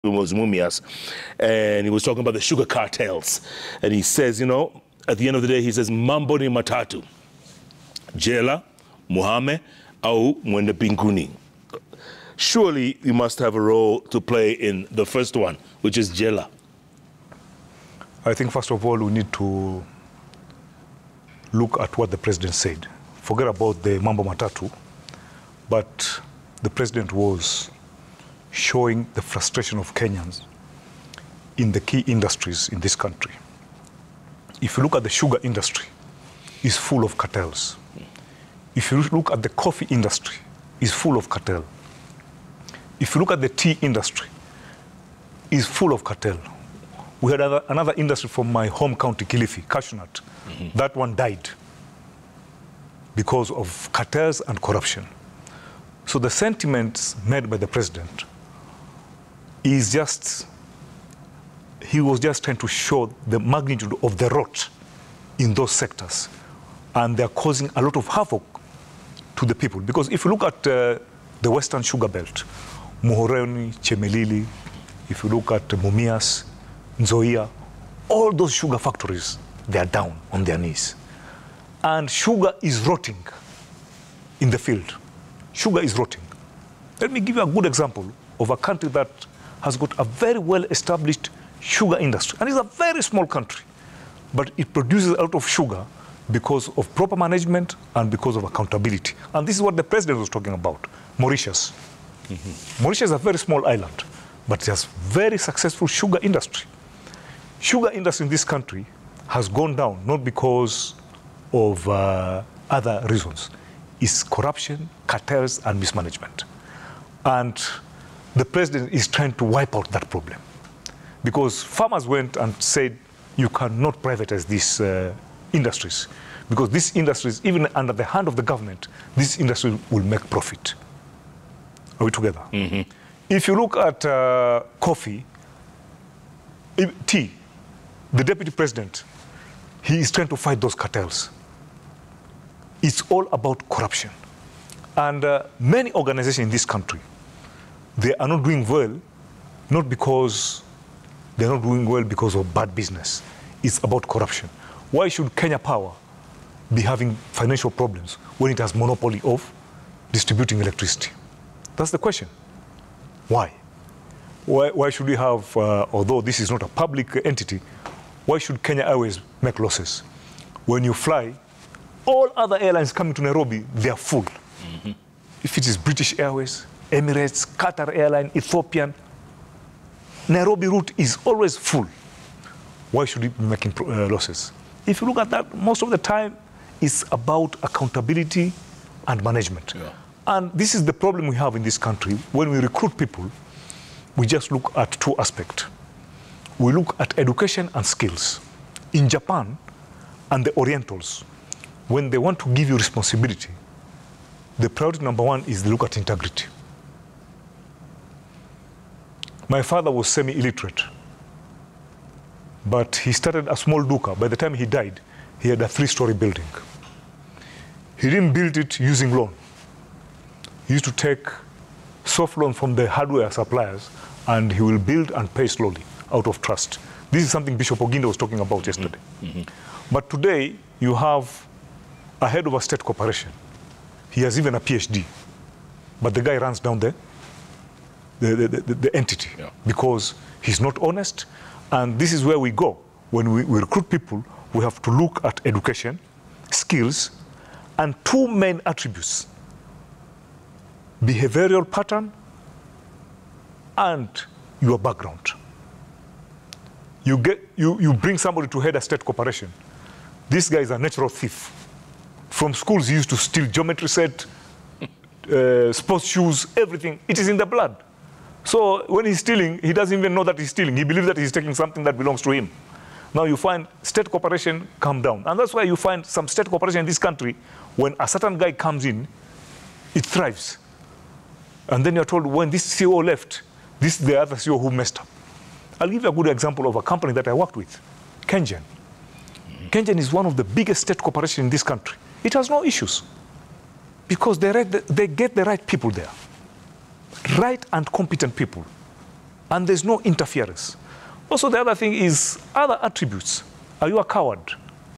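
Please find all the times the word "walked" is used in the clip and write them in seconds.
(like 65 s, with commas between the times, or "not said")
not said.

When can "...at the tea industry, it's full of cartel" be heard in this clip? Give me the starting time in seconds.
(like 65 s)
43 s.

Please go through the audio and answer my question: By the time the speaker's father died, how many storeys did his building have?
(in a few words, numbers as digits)
3.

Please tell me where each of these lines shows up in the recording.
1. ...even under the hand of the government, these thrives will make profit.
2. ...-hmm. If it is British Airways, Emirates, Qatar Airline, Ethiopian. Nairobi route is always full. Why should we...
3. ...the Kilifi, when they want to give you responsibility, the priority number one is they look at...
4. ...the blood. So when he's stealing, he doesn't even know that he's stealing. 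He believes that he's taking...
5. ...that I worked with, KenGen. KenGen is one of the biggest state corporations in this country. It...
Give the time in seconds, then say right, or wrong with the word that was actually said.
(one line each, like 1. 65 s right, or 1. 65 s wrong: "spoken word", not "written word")
1. 127 s wrong: "industries", not "thrives"
2. 174 s right
3. 200 s wrong: "Orientals", not "Kilifi"
4. 267 s right
5. 287 s right.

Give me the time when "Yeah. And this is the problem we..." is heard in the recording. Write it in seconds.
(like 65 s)
189 s.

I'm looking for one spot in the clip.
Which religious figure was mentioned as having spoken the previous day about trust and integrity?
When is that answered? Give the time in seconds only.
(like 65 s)
227 s.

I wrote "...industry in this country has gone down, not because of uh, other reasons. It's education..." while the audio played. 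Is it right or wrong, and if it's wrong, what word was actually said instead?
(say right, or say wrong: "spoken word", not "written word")
wrong: "corruption", not "education".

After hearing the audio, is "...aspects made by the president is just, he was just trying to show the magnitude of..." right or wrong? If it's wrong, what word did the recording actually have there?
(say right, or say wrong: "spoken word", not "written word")
wrong: "sentiments", not "aspects".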